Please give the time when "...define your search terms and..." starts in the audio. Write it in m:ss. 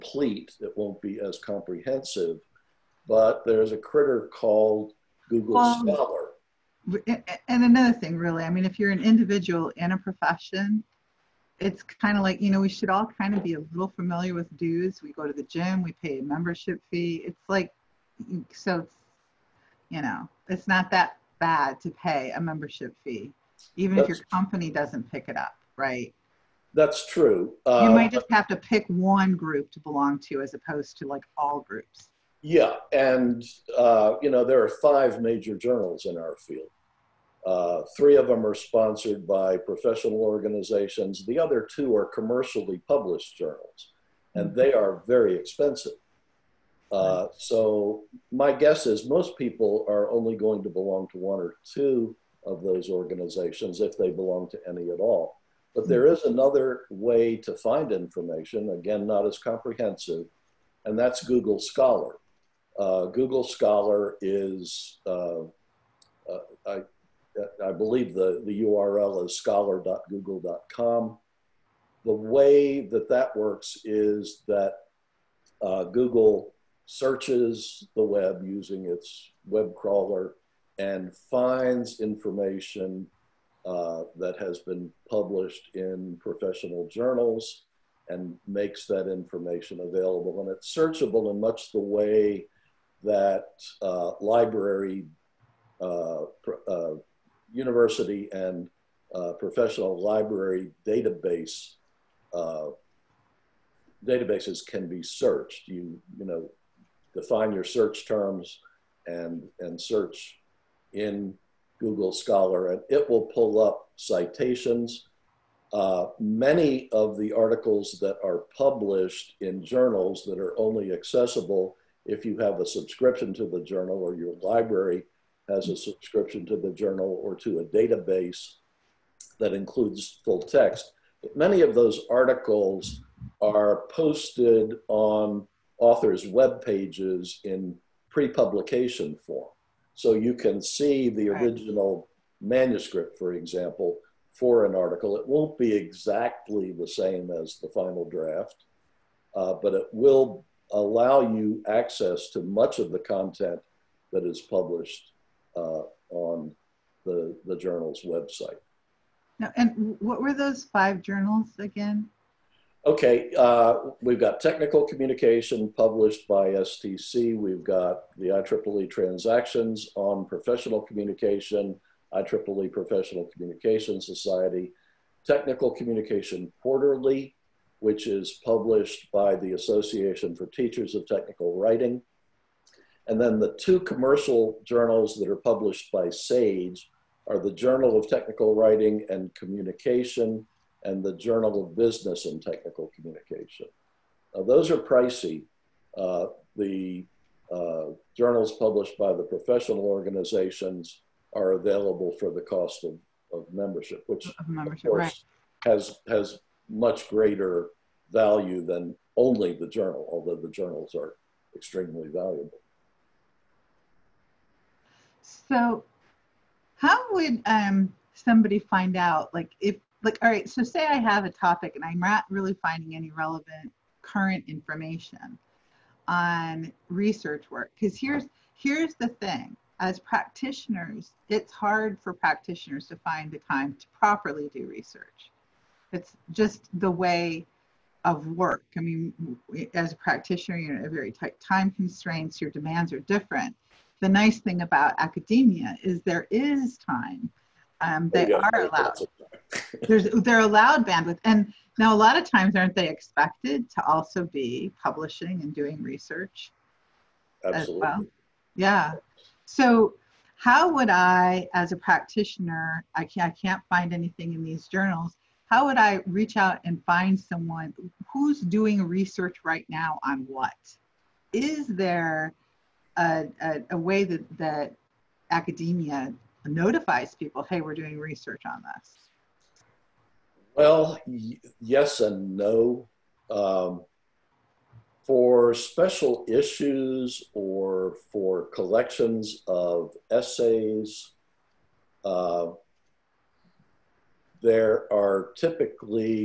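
1:47.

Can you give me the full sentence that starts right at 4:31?
Is there a, a, a way that, that academia notifies people, hey, we're doing research on this?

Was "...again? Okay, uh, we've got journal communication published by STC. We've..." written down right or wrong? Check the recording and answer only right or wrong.
wrong.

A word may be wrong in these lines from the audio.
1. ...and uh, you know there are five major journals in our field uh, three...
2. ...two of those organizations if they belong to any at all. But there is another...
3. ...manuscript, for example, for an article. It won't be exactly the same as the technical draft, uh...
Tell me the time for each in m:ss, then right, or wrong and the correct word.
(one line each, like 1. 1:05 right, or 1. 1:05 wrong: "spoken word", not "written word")
1. 0:32 right
2. 0:51 right
3. 2:22 wrong: "final", not "technical".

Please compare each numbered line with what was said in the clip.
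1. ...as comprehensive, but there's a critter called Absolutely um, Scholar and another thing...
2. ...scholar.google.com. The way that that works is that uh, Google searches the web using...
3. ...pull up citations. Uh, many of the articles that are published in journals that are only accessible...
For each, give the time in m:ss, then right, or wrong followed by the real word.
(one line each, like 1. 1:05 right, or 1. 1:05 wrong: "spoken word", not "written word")
1. 0:01 wrong: "Google", not "Absolutely"
2. 1:09 right
3. 1:53 right.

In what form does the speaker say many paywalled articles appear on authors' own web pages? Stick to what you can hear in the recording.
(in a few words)
pre publication form.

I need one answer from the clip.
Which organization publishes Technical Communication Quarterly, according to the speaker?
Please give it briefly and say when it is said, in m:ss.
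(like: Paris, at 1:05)
Association for Teachers of Technical Writing, at 2:59.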